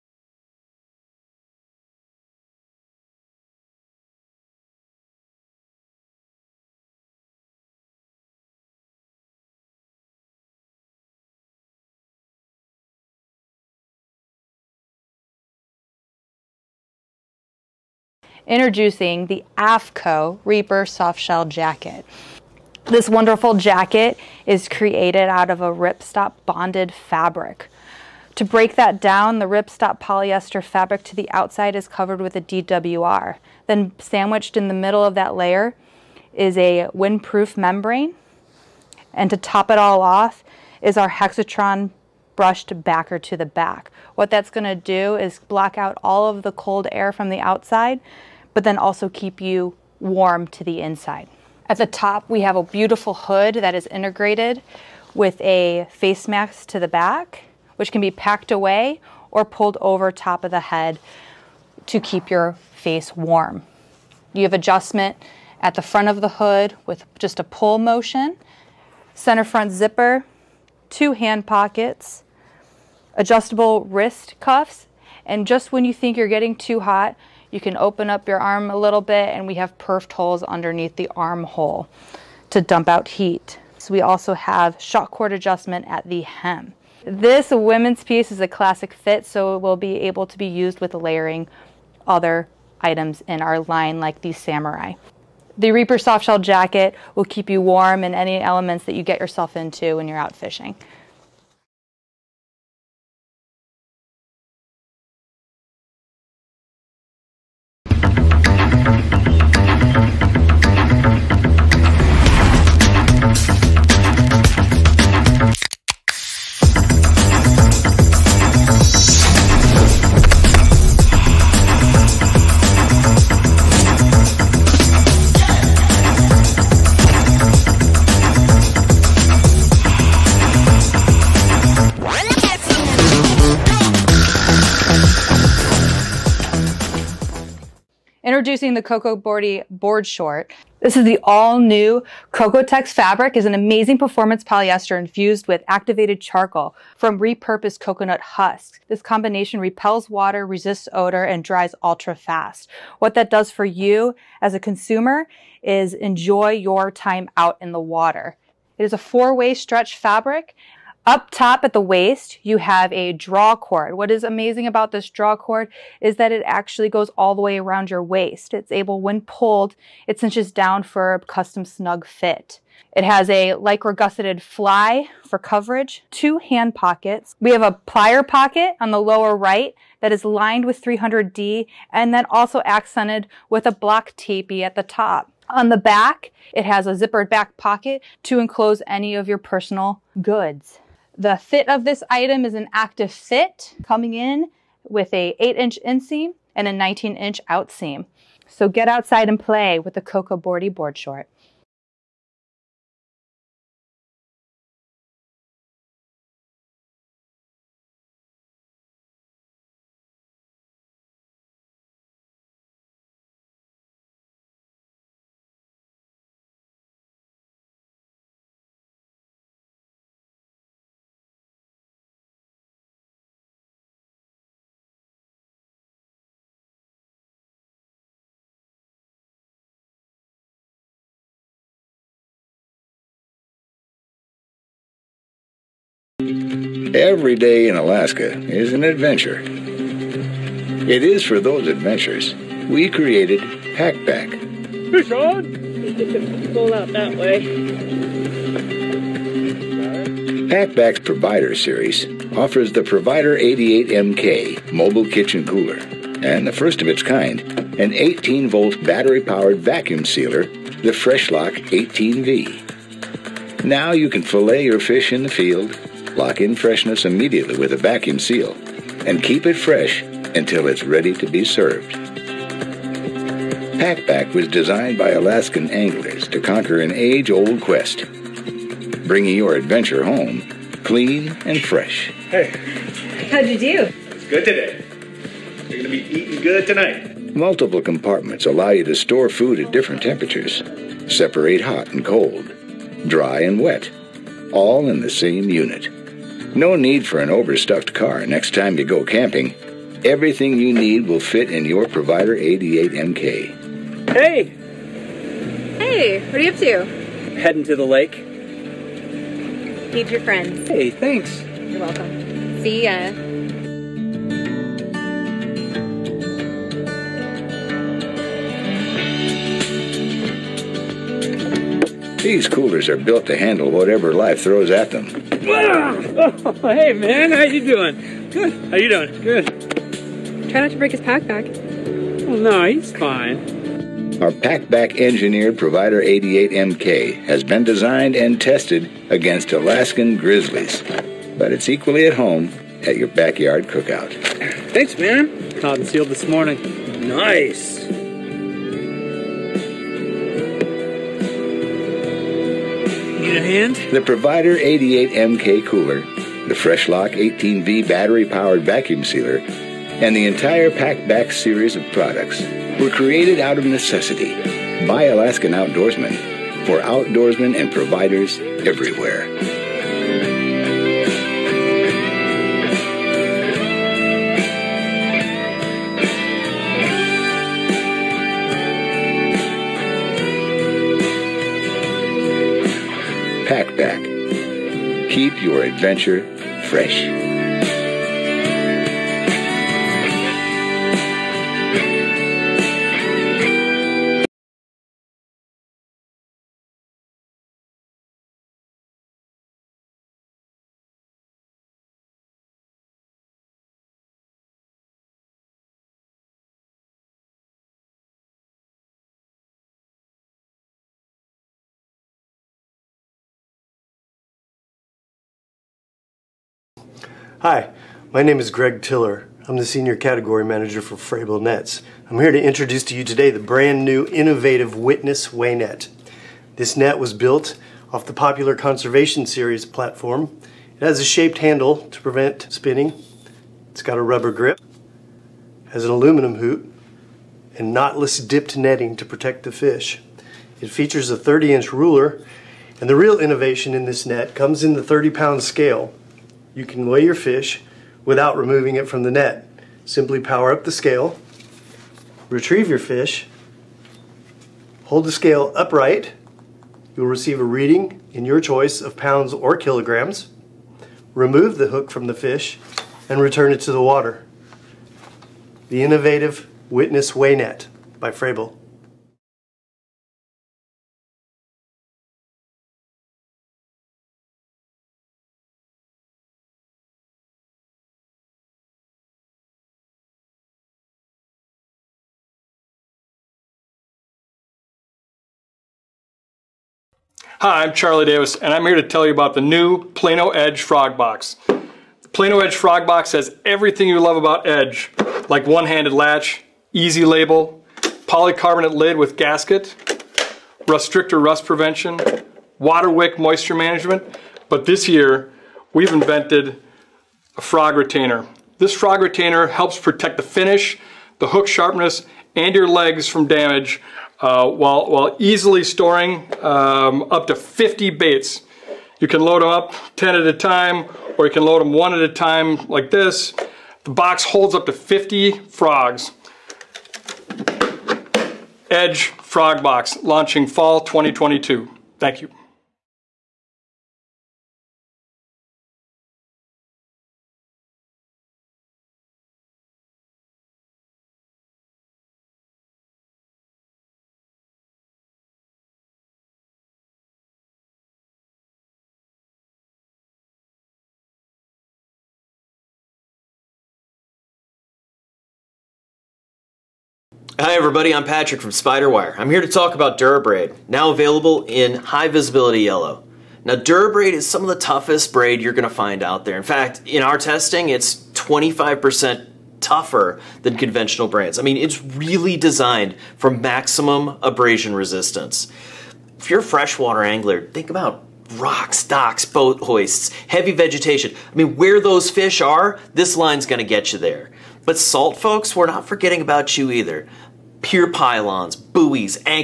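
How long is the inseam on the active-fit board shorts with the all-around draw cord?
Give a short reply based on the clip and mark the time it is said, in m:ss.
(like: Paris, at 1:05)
8 inches, at 3:15.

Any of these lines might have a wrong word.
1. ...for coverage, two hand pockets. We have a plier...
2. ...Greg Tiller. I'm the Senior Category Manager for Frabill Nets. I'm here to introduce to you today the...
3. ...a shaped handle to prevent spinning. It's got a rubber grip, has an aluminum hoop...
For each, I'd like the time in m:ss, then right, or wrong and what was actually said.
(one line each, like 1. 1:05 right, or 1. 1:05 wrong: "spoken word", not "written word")
1. 2:55 right
2. 6:58 right
3. 7:10 right.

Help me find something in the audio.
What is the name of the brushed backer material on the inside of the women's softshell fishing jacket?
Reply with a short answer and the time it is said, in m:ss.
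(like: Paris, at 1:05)
Hexatron, at 0:41.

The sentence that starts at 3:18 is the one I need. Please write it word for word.
So get outside and play with the Cocoa Boardy board short.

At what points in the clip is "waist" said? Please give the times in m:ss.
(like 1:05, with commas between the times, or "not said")
2:41, 2:48.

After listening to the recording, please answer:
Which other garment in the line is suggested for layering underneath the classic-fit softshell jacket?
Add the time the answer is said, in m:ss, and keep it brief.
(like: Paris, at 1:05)
Samurai, at 1:34.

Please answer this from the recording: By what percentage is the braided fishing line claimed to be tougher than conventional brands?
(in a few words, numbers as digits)
25%.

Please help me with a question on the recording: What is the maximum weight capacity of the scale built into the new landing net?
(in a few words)
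30 pounds.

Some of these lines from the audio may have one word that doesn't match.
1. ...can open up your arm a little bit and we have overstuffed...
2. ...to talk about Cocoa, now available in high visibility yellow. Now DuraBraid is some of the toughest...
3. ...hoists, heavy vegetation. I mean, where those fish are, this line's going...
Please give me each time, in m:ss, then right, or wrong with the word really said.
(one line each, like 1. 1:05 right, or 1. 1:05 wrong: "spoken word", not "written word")
1. 1:17 wrong: "perfed", not "overstuffed"
2. 9:19 wrong: "DuraBraid", not "Cocoa"
3. 9:39 right.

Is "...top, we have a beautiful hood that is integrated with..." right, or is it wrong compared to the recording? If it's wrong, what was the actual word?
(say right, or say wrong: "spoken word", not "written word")
right.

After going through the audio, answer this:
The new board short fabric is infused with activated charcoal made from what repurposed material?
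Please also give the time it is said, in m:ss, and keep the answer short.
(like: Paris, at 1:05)
Coconut husks, at 2:27.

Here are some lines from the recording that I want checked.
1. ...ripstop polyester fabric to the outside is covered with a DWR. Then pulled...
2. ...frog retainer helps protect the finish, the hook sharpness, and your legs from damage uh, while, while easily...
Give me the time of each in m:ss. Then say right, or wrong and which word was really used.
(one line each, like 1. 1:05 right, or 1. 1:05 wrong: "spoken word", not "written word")
1. 0:29 wrong: "sandwiched", not "pulled"
2. 8:28 right.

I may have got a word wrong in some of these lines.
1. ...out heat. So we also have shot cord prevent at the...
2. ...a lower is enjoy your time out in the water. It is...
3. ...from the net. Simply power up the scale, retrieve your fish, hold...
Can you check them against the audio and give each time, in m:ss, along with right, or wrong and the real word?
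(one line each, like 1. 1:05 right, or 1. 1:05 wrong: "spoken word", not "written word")
1. 1:22 wrong: "adjustment", not "prevent"
2. 2:34 wrong: "consumer", not "lower"
3. 7:28 right.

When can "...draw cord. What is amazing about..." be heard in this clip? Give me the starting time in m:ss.
2:43.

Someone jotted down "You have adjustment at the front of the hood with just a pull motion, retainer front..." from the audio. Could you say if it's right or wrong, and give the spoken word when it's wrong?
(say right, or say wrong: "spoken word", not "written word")
wrong: "center", not "retainer".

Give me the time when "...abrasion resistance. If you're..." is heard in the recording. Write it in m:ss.
9:34.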